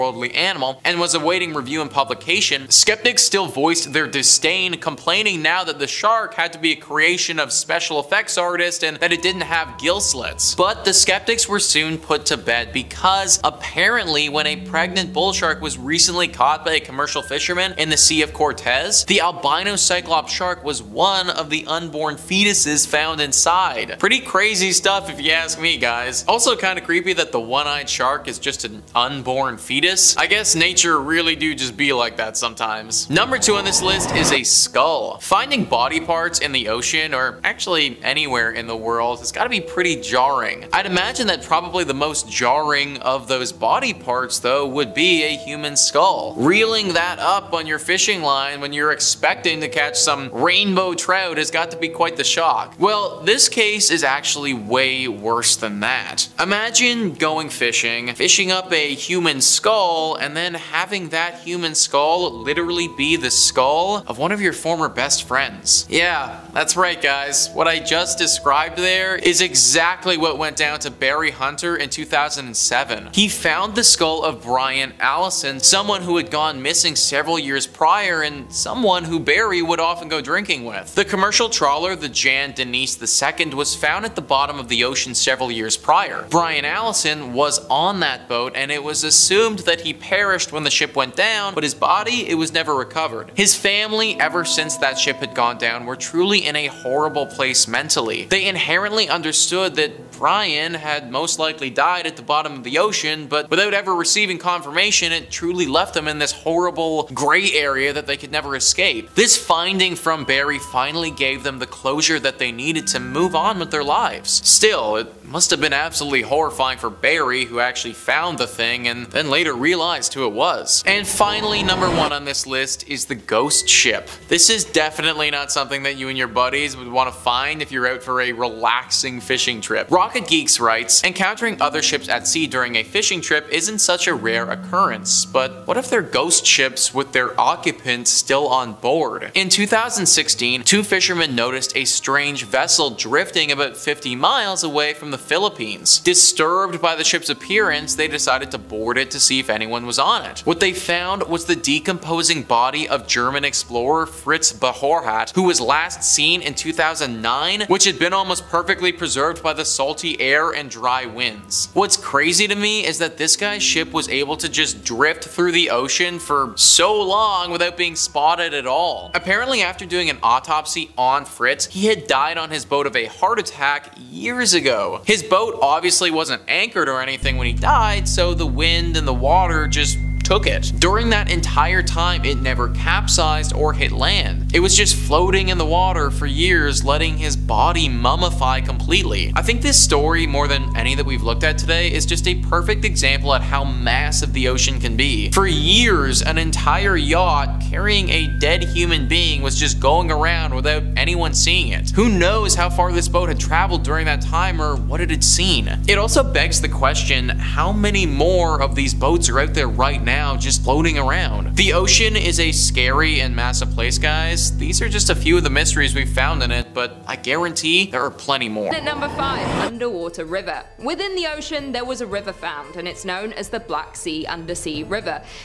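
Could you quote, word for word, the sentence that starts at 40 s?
I'd imagine that probably the most jarring of those body parts, though, would be a human skull.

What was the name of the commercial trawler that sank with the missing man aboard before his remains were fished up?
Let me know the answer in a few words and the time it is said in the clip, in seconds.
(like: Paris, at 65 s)
Jan Denise II, at 82 s.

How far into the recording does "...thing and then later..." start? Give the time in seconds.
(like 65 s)
118 s.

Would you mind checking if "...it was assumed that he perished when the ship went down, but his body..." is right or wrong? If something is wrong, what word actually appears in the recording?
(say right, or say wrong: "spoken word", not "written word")
right.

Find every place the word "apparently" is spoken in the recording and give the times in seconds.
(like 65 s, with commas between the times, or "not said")
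13 s, 169 s.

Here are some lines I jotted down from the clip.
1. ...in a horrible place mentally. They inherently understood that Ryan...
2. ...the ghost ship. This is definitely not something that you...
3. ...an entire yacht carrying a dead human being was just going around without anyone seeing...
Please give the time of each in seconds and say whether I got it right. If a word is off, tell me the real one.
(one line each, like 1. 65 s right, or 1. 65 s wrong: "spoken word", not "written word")
1. 96 s right
2. 123 s right
3. 196 s right.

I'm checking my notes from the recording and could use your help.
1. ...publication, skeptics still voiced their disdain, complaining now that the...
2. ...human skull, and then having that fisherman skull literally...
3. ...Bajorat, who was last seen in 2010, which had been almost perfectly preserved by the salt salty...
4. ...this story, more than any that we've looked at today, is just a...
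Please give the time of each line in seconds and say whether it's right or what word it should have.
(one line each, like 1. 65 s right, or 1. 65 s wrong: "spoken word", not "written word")
1. 1 s right
2. 58 s wrong: "human", not "fisherman"
3. 154 s wrong: "2009", not "2010"
4. 189 s right.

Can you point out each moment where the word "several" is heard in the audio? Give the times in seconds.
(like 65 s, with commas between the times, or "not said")
76 s, 85 s.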